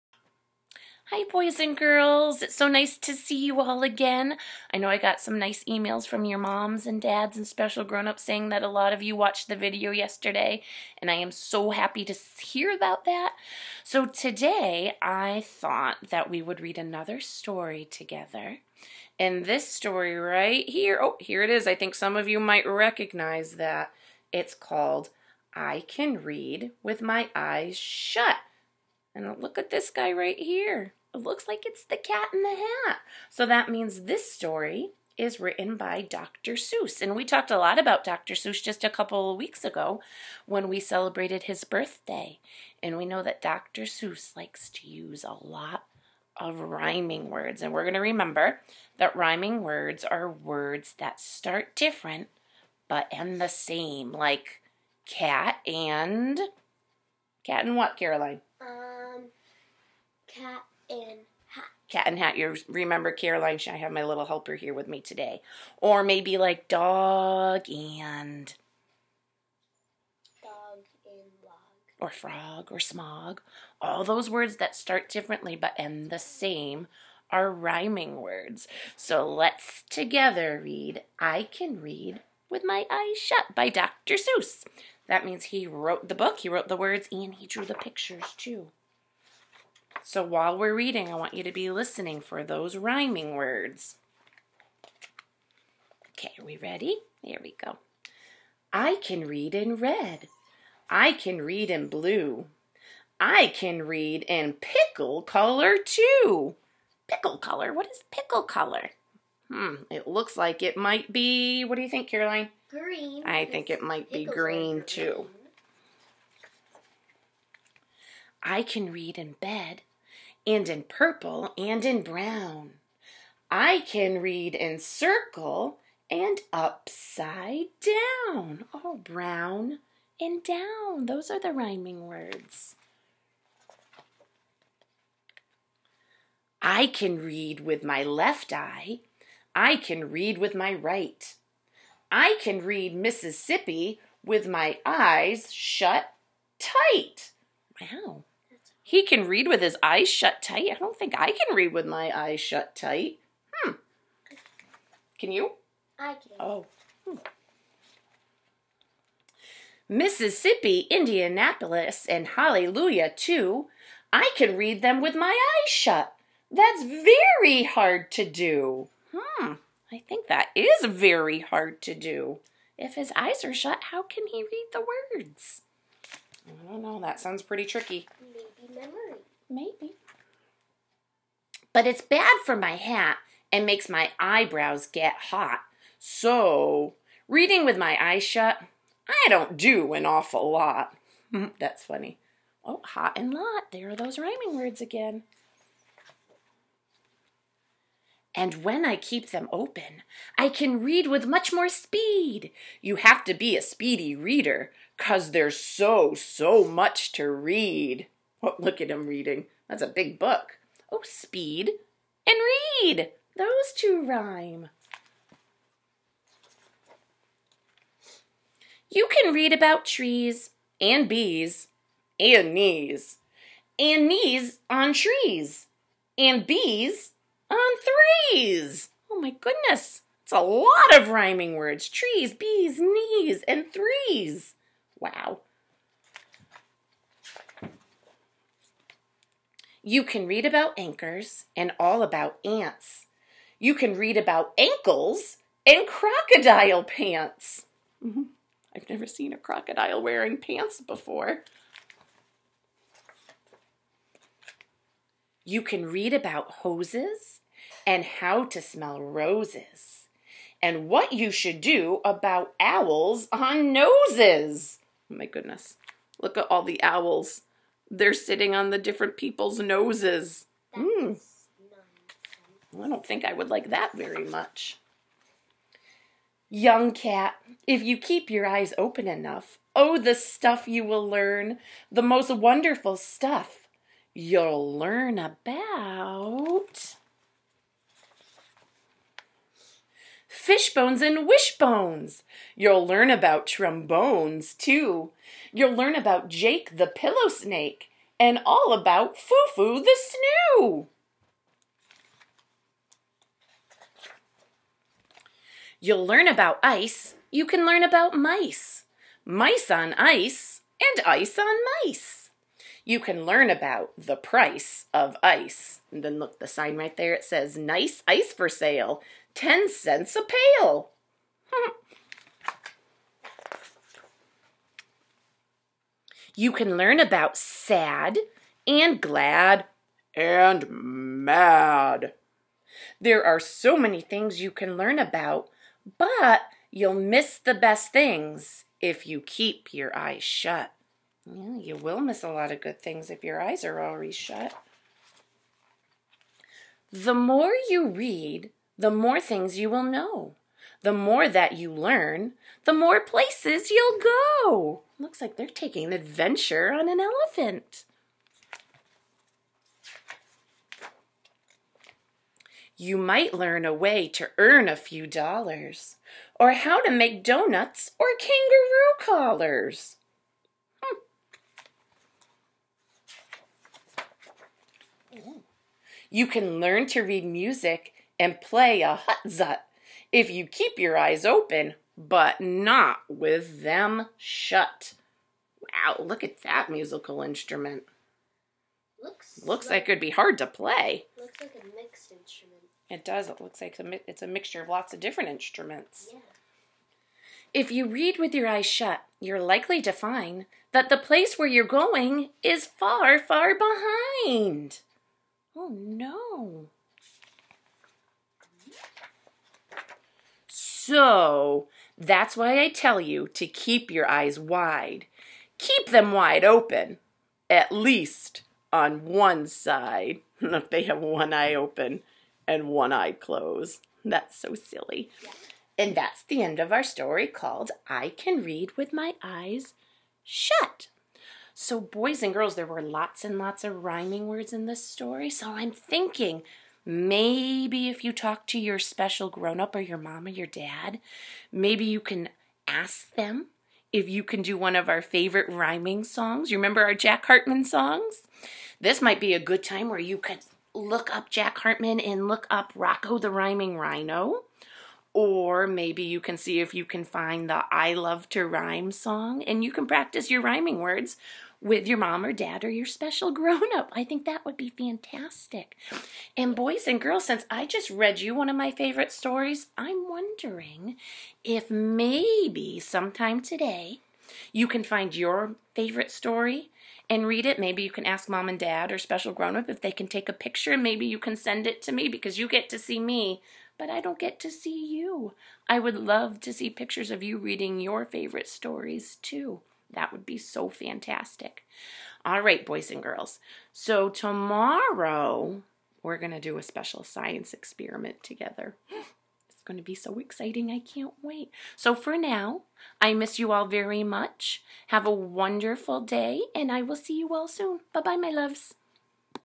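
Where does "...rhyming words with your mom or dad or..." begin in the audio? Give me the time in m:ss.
7:40.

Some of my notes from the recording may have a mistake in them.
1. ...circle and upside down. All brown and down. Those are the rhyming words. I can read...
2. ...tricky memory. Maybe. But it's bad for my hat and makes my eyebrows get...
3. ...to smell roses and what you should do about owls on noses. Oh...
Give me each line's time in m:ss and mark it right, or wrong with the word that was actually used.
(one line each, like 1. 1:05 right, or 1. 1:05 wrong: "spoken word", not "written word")
1. 2:04 right
2. 2:57 right
3. 4:18 right.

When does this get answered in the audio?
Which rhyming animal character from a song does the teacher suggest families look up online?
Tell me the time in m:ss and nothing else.
7:32.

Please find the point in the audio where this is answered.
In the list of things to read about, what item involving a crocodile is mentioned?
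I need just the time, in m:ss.
4:05.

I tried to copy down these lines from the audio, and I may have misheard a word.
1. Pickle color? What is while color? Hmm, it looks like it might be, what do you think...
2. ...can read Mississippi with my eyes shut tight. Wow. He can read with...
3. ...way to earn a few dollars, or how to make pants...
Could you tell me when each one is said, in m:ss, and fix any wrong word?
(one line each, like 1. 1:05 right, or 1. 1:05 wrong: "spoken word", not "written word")
1. 1:47 wrong: "pickle", not "while"
2. 2:22 right
3. 6:03 wrong: "donuts", not "pants".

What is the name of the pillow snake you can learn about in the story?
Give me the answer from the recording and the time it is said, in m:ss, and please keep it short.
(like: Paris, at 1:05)
Jake, at 4:56.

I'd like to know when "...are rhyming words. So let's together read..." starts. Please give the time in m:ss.
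1:17.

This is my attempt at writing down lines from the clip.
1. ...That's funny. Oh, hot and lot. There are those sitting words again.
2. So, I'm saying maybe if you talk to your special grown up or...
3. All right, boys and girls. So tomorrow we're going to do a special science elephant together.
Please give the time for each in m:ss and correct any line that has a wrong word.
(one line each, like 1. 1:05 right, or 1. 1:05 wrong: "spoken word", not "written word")
1. 3:11 wrong: "rhyming", not "sitting"
2. 7:15 wrong: "thinking", not "saying"
3. 8:12 wrong: "experiment", not "elephant".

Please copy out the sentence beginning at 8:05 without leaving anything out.
I would love to see pictures of you reading your favorite stories too.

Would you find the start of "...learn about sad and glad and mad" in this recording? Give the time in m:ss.
5:26.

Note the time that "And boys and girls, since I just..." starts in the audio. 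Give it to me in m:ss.
7:46.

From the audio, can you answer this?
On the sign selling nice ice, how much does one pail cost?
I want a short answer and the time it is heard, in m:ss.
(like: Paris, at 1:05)
10 cents, at 5:19.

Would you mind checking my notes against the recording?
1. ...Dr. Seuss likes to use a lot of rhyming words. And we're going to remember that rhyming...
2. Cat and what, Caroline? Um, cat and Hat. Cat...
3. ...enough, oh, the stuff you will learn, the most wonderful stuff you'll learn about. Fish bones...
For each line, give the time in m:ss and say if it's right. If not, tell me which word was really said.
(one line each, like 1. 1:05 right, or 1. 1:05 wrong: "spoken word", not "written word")
1. 0:43 right
2. 0:57 right
3. 4:39 right.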